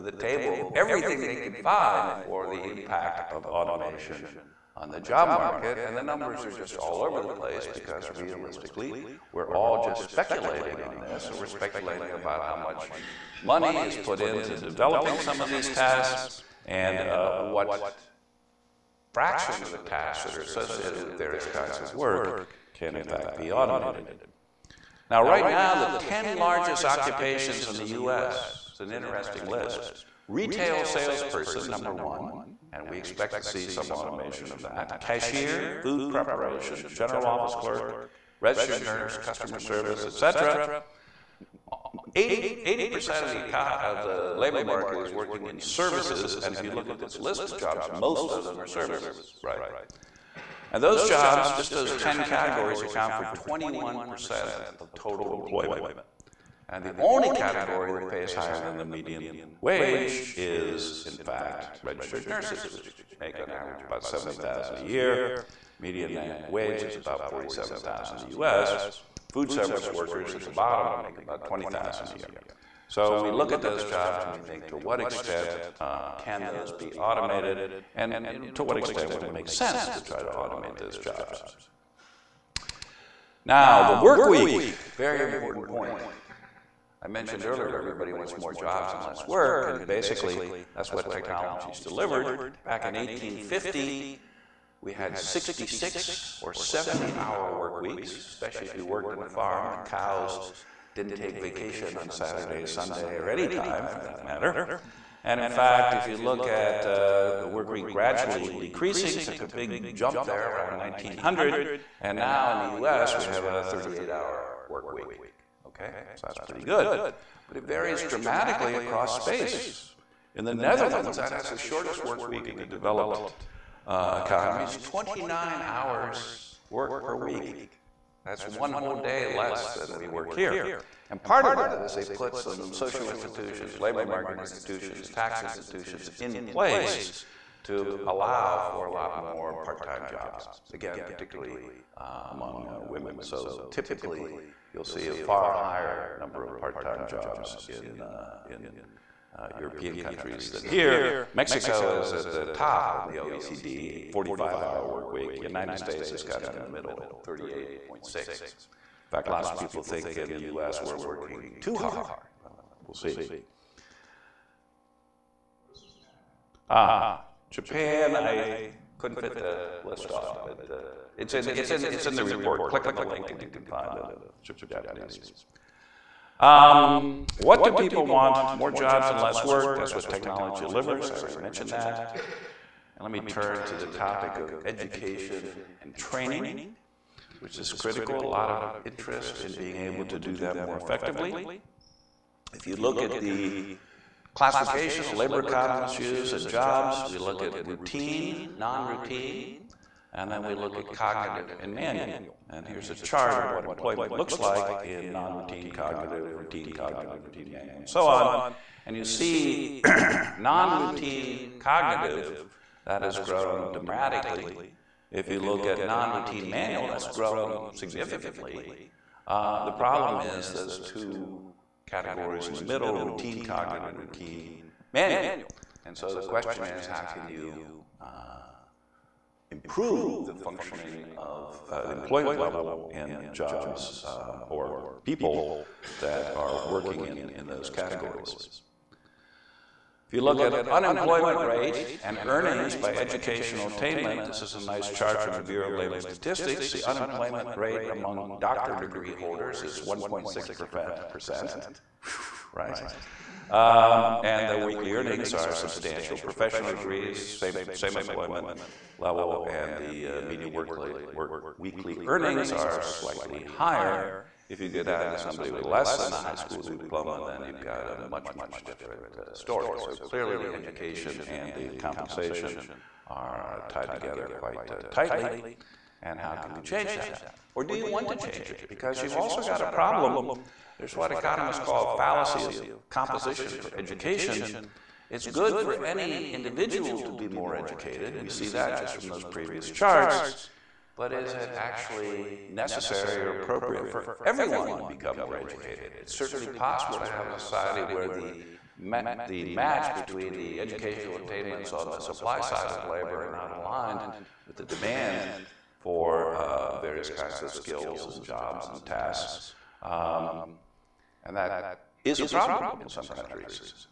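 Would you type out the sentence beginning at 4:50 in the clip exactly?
But is it actually necessary or appropriate for everyone to become more educated?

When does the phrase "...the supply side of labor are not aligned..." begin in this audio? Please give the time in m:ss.
5:01.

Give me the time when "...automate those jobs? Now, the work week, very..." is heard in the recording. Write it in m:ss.
1:20.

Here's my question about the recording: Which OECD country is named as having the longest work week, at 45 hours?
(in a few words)
Mexico.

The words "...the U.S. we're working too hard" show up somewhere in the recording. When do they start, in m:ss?
2:40.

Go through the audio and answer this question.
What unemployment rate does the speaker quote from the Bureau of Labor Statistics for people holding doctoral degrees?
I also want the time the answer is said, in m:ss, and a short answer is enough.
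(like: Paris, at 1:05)
1.6%, at 4:09.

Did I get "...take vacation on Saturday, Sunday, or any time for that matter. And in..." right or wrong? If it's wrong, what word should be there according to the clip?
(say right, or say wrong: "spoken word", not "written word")
right.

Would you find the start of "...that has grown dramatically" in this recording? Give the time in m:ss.
3:32.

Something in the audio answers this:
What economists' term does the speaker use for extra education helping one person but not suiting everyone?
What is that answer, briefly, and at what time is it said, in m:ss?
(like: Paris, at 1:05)
fallacy of composition, at 4:41.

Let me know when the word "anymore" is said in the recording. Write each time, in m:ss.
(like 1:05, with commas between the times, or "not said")
not said.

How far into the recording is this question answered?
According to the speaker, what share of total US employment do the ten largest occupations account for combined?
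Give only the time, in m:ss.
0:53.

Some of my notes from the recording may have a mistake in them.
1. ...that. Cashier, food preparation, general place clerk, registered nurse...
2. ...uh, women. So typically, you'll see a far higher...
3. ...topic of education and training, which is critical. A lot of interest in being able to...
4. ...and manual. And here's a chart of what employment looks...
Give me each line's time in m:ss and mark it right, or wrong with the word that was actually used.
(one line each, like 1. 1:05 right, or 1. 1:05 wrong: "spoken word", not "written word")
1. 0:34 wrong: "office", not "place"
2. 2:22 right
3. 3:03 right
4. 3:21 right.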